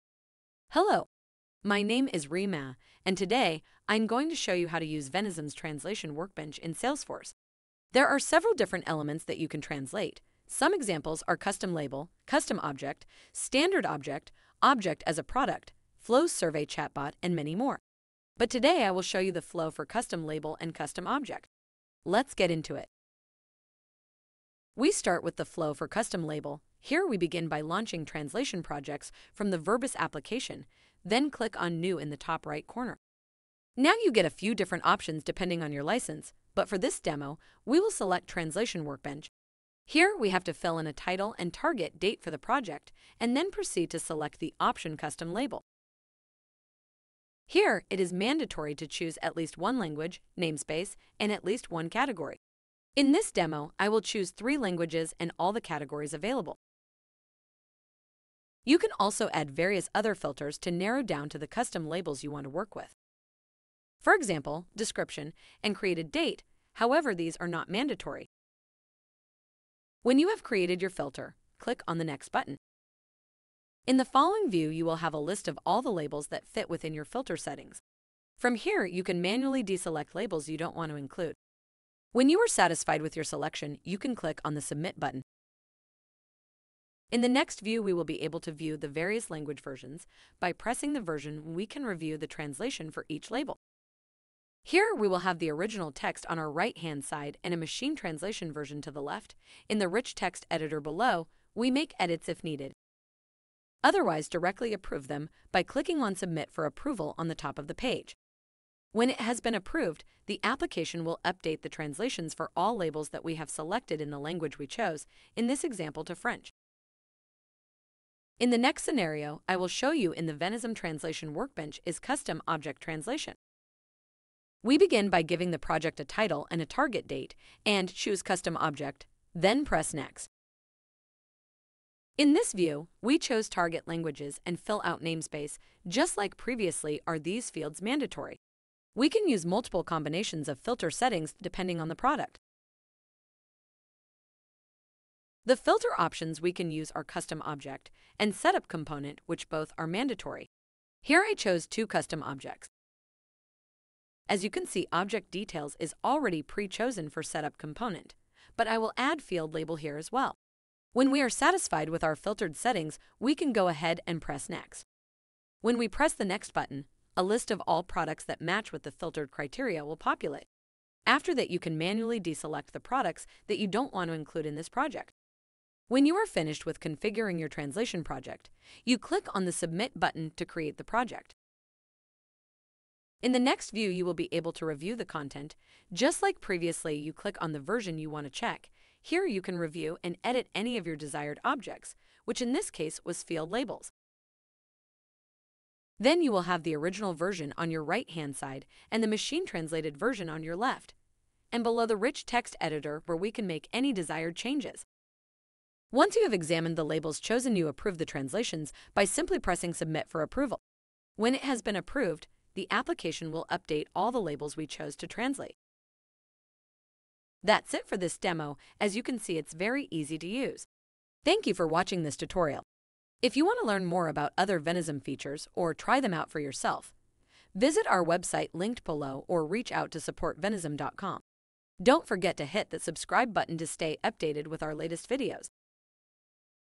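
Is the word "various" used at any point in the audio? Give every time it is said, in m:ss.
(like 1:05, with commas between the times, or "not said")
0:59, 1:28.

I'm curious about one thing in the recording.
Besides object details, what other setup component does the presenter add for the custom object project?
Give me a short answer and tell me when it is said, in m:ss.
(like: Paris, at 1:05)
field label, at 2:39.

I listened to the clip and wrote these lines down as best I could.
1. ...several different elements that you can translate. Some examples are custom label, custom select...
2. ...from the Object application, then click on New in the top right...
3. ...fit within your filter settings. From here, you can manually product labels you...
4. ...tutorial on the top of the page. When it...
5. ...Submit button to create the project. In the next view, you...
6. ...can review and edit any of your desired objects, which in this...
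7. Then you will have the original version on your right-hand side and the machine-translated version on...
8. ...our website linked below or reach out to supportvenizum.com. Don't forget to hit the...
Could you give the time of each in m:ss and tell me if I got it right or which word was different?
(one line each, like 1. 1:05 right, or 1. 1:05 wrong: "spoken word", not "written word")
1. 0:08 wrong: "object", not "select"
2. 0:29 wrong: "Verbis", not "Object"
3. 1:16 wrong: "deselect", not "product"
4. 1:46 wrong: "approval", not "tutorial"
5. 2:59 right
6. 3:09 right
7. 3:15 right
8. 3:47 right.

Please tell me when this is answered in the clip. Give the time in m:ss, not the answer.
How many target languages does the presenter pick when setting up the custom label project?
0:54.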